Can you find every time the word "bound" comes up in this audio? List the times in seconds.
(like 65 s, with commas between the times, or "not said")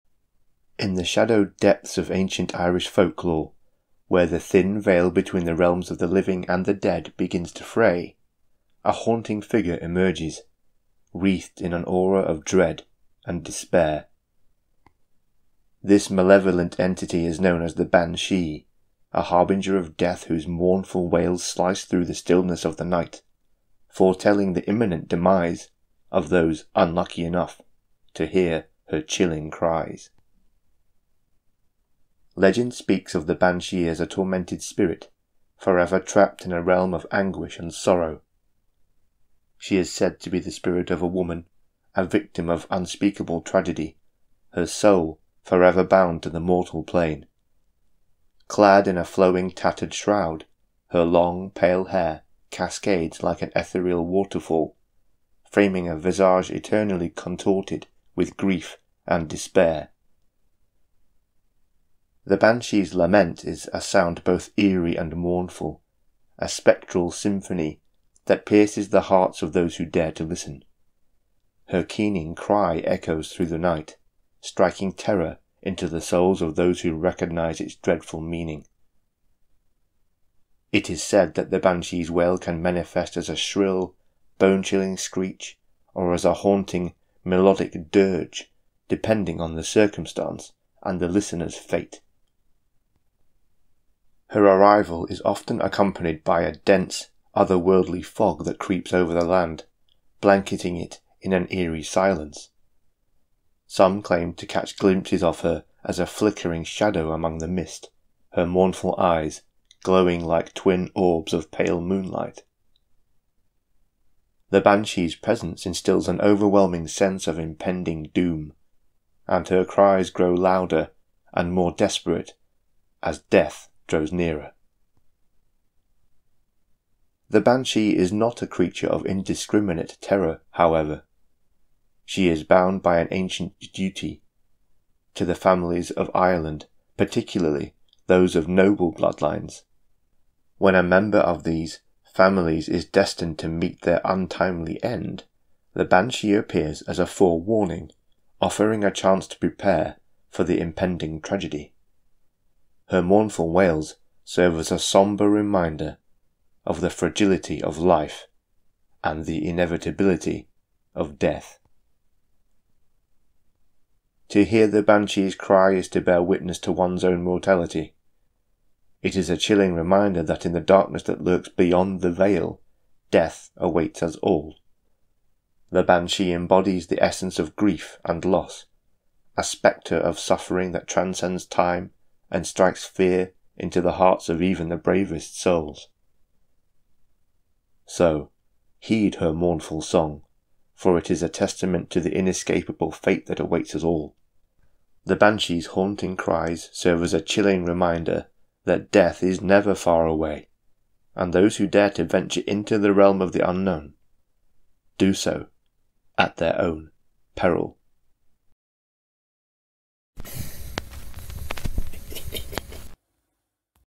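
45 s, 132 s.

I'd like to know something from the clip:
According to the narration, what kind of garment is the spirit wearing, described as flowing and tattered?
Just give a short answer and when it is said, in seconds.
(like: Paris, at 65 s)
shroud, at 49 s.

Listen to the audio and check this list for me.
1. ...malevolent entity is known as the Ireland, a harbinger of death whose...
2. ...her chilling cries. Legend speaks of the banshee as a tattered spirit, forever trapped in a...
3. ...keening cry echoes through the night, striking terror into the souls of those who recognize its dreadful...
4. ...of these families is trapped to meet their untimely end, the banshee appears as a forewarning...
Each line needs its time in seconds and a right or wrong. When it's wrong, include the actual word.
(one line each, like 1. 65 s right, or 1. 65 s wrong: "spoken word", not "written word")
1. 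16 s wrong: "Banshee", not "Ireland"
2. 28 s wrong: "tormented", not "tattered"
3. 71 s right
4. 141 s wrong: "destined", not "trapped".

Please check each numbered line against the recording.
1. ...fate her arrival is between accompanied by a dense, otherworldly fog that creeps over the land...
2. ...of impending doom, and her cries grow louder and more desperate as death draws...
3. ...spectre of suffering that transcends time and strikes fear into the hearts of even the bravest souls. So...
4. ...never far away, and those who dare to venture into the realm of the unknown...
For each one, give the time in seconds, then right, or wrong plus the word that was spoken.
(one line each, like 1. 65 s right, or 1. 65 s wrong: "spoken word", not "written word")
1. 91 s wrong: "often", not "between"
2. 117 s right
3. 179 s right
4. 199 s right.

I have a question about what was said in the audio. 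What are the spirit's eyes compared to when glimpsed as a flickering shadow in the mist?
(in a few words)
pale moonlight.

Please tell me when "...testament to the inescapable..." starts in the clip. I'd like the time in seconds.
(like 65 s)
191 s.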